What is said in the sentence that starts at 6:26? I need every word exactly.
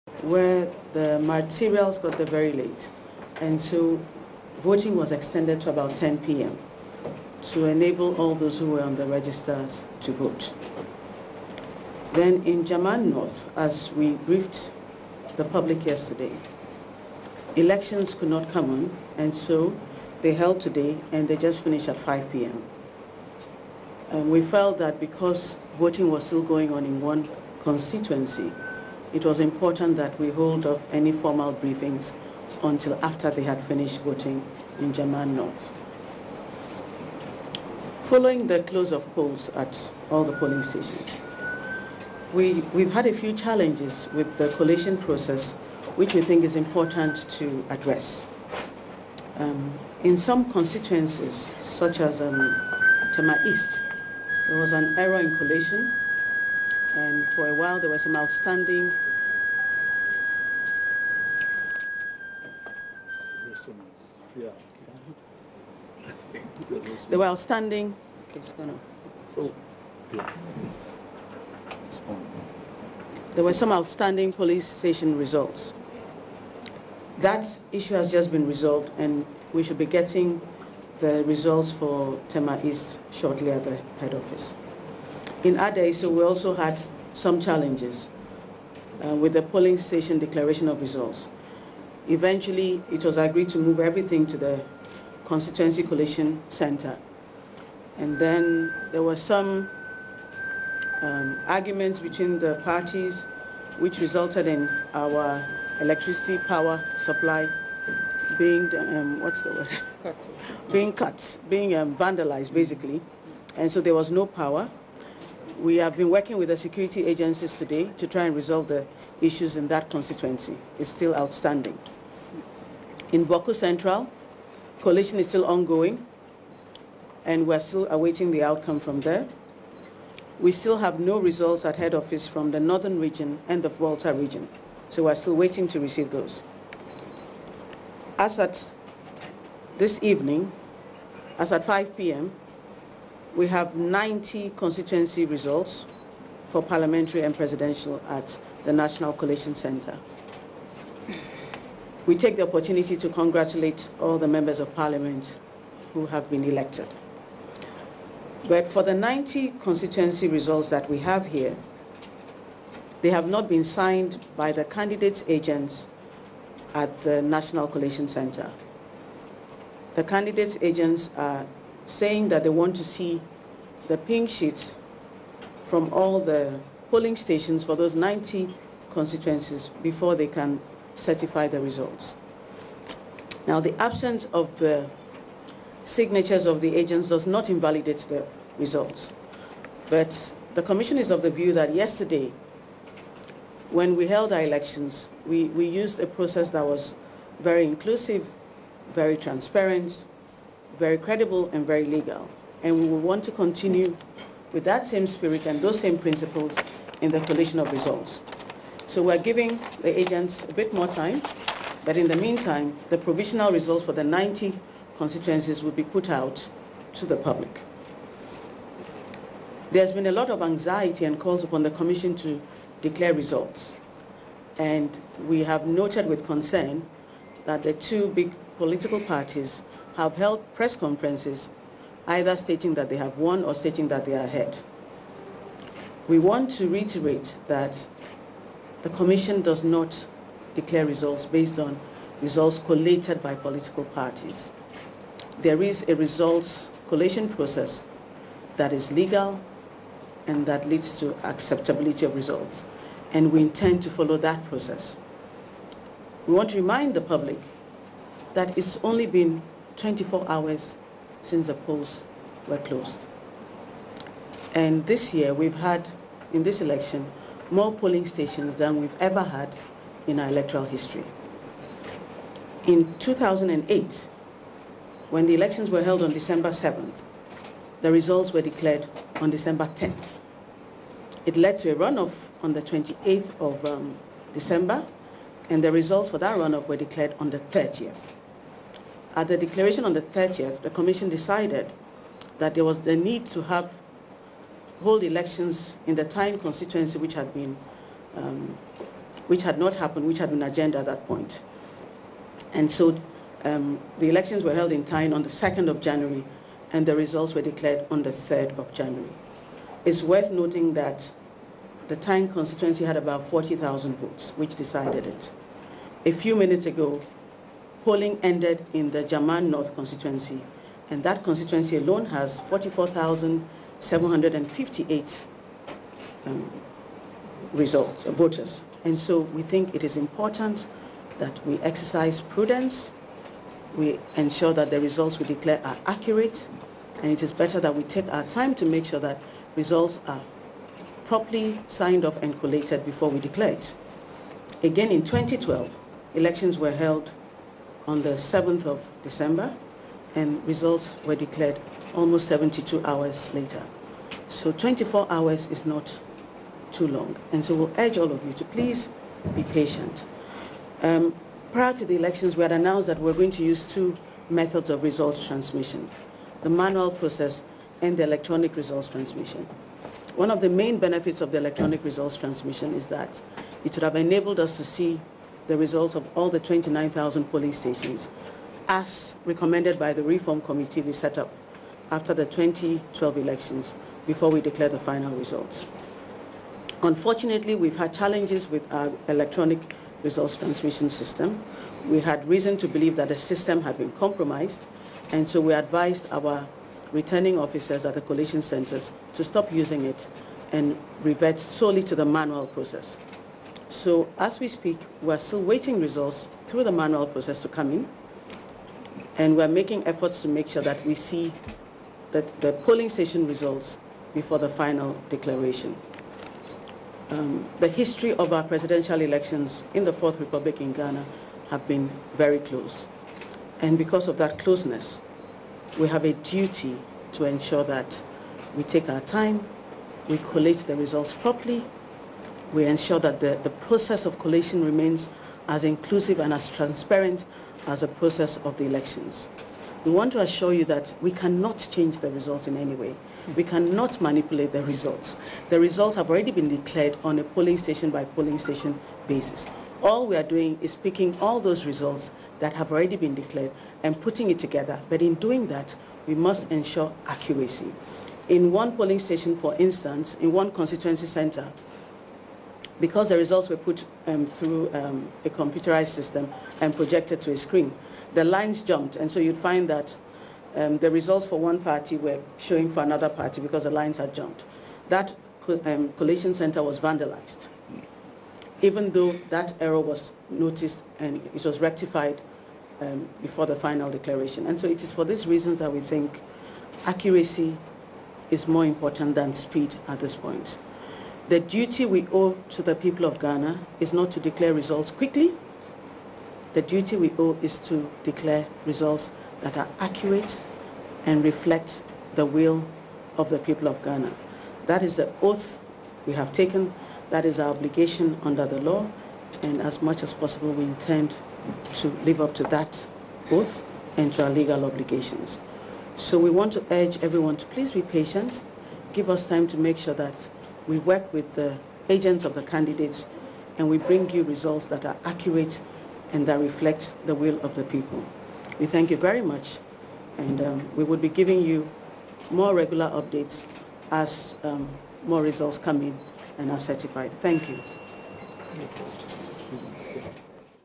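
Unfortunately, we've had challenges with our electronic results transmission system.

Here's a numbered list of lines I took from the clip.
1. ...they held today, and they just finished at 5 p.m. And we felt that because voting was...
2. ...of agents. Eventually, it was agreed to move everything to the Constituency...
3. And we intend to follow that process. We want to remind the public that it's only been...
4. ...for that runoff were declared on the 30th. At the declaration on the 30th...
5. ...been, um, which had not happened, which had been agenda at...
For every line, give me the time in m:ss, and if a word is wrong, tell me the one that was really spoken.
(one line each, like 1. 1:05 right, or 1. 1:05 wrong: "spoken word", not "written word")
1. 0:20 right
2. 1:30 wrong: "results", not "agents"
3. 4:13 right
4. 4:46 right
5. 4:57 right.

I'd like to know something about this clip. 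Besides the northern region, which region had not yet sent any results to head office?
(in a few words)
Volta region.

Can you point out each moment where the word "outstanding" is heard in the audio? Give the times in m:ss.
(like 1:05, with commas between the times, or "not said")
0:58, 1:07, 1:13, 2:01.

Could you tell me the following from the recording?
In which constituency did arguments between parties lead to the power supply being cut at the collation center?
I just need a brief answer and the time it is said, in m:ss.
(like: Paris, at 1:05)
Adaiso, at 1:25.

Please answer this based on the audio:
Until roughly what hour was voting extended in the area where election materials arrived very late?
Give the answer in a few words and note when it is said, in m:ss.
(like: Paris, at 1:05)
10 p.m., at 0:05.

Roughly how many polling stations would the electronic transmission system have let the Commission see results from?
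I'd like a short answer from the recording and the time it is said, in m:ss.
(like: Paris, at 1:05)
29,000, at 6:16.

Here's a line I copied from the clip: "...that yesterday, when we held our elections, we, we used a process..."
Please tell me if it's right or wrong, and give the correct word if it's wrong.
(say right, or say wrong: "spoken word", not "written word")
right.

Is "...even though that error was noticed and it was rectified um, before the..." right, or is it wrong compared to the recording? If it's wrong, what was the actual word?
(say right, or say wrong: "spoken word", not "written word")
right.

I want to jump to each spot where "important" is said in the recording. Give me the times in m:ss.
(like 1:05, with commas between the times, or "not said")
0:29, 0:46, 5:29, 8:08.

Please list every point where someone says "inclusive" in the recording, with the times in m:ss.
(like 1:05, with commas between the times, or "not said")
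3:17, 7:15.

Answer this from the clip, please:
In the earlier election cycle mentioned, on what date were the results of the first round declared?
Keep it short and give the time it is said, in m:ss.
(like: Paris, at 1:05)
December 10th, at 4:39.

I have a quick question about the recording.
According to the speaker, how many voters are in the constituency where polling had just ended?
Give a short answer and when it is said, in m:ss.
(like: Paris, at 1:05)
44,758, at 5:22.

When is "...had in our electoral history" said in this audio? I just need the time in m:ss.
4:29.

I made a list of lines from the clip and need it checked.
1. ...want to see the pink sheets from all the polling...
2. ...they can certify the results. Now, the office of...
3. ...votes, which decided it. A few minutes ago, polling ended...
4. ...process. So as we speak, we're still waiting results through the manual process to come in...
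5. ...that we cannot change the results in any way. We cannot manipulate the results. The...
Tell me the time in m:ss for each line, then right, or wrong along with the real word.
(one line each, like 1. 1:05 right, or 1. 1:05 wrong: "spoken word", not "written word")
1. 2:52 right
2. 3:00 wrong: "absence", not "office"
3. 5:13 right
4. 6:42 right
5. 7:20 right.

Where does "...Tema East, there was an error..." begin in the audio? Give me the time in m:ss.
0:53.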